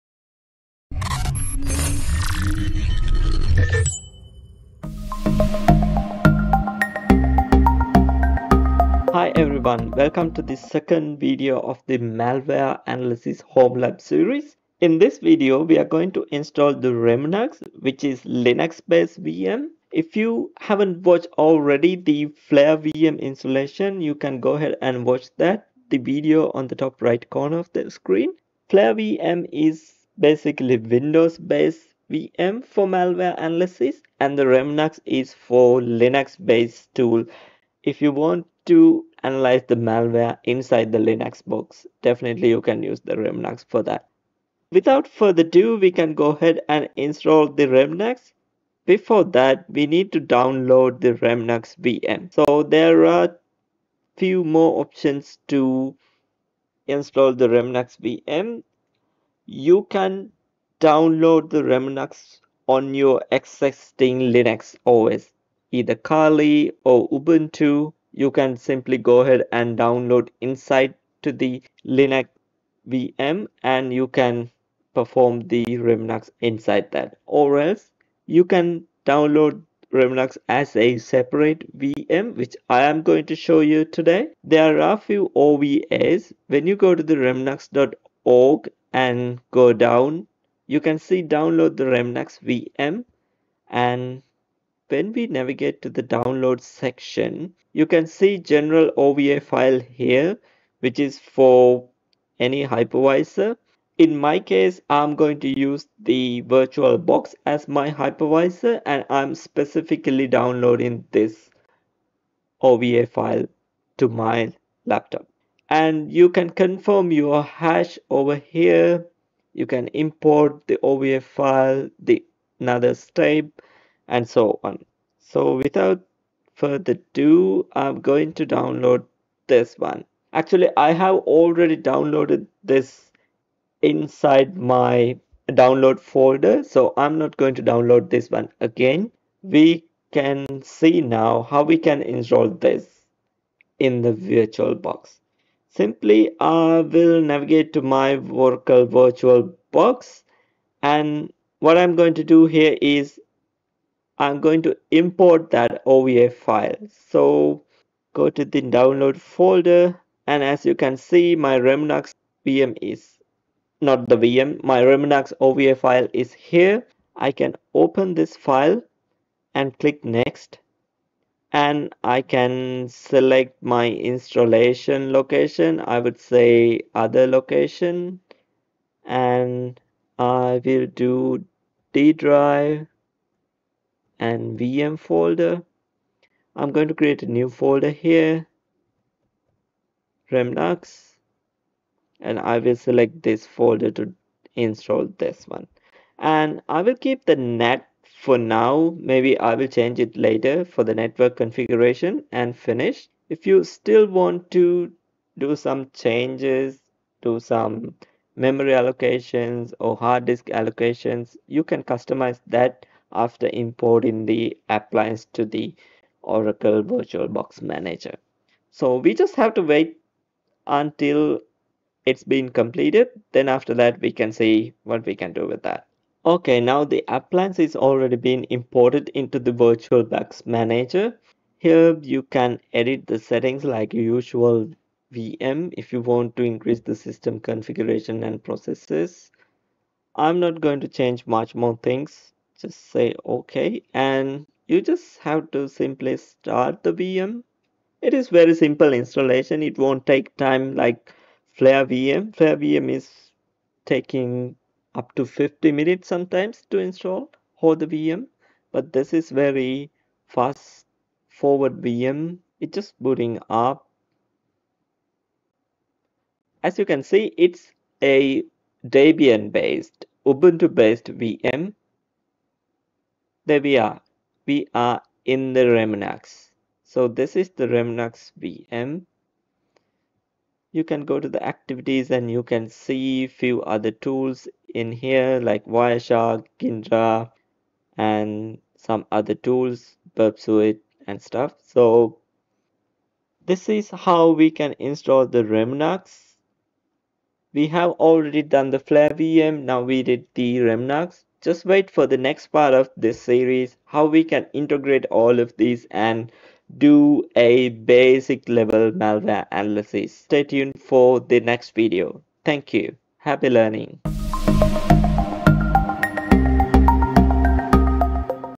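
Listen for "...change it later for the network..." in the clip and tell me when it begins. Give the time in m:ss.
3:19.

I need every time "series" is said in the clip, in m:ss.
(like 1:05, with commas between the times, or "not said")
0:14, 5:03.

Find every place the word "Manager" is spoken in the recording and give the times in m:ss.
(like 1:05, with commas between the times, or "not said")
3:37, 3:50.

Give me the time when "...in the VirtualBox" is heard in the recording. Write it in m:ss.
2:23.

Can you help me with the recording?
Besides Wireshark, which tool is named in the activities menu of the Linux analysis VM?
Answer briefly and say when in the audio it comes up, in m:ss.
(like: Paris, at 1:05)
Ghidra, at 4:46.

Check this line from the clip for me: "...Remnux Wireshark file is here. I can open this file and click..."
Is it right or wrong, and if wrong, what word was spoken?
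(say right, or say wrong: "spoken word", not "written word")
wrong: "OVA", not "Wireshark".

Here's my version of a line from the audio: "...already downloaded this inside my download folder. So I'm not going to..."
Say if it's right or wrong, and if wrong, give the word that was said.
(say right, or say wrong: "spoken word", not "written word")
right.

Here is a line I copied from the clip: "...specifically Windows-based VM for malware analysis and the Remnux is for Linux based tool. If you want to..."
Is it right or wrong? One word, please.
wrong.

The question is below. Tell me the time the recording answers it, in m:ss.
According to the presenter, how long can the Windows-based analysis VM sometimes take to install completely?
4:15.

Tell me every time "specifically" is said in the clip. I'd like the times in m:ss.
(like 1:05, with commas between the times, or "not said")
1:49.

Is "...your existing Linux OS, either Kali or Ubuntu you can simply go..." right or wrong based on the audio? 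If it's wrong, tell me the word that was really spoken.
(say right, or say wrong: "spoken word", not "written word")
right.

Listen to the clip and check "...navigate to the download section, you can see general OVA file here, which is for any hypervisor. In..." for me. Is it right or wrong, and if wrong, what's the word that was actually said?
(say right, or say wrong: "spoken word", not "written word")
right.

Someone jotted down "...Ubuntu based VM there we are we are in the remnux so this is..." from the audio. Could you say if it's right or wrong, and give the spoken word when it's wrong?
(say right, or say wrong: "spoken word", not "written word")
right.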